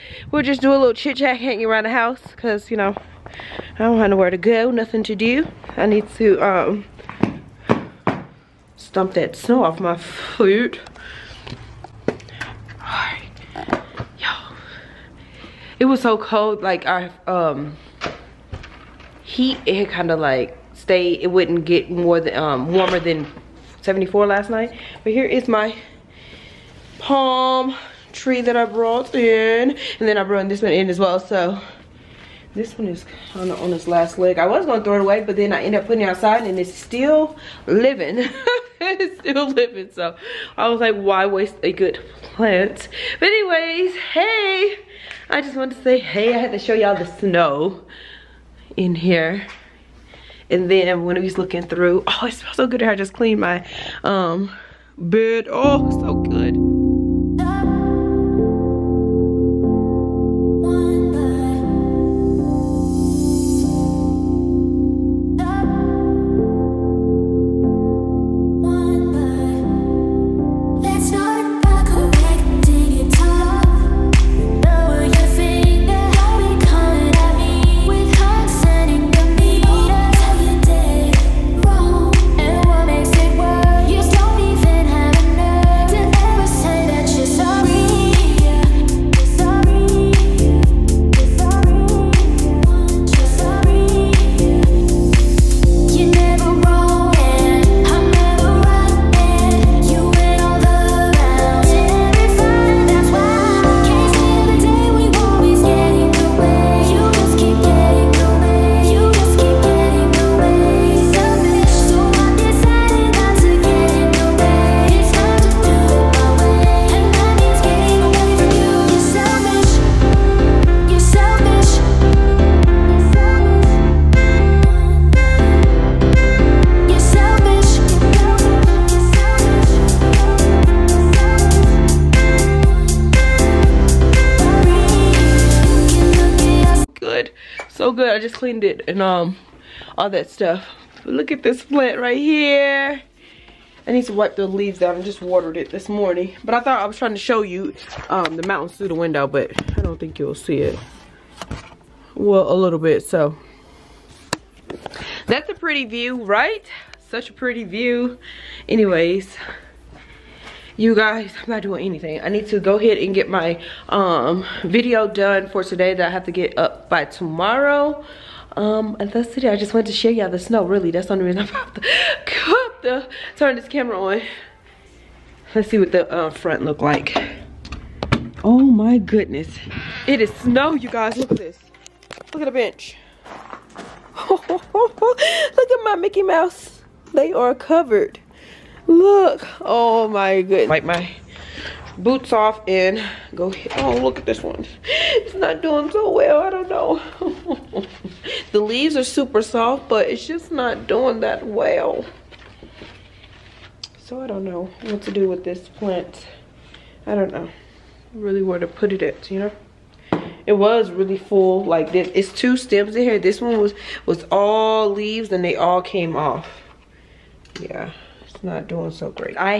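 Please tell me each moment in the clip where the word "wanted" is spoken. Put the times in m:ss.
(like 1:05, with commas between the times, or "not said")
0:45, 2:49.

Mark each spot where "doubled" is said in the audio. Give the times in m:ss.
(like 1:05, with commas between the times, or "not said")
not said.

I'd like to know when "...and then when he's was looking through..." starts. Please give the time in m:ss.
0:50.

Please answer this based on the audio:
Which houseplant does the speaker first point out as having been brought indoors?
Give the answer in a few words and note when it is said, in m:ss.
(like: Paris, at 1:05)
Palm tree, at 0:26.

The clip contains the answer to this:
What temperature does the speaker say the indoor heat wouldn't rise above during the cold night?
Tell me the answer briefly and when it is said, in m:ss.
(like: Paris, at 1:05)
74, at 0:23.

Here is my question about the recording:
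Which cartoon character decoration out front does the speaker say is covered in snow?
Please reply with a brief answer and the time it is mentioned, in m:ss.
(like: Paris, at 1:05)
Mickey Mouse, at 3:05.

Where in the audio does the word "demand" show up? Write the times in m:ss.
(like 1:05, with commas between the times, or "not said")
not said.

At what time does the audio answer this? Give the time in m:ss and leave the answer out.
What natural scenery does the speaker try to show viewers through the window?
2:28.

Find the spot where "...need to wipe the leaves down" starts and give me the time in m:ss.
2:23.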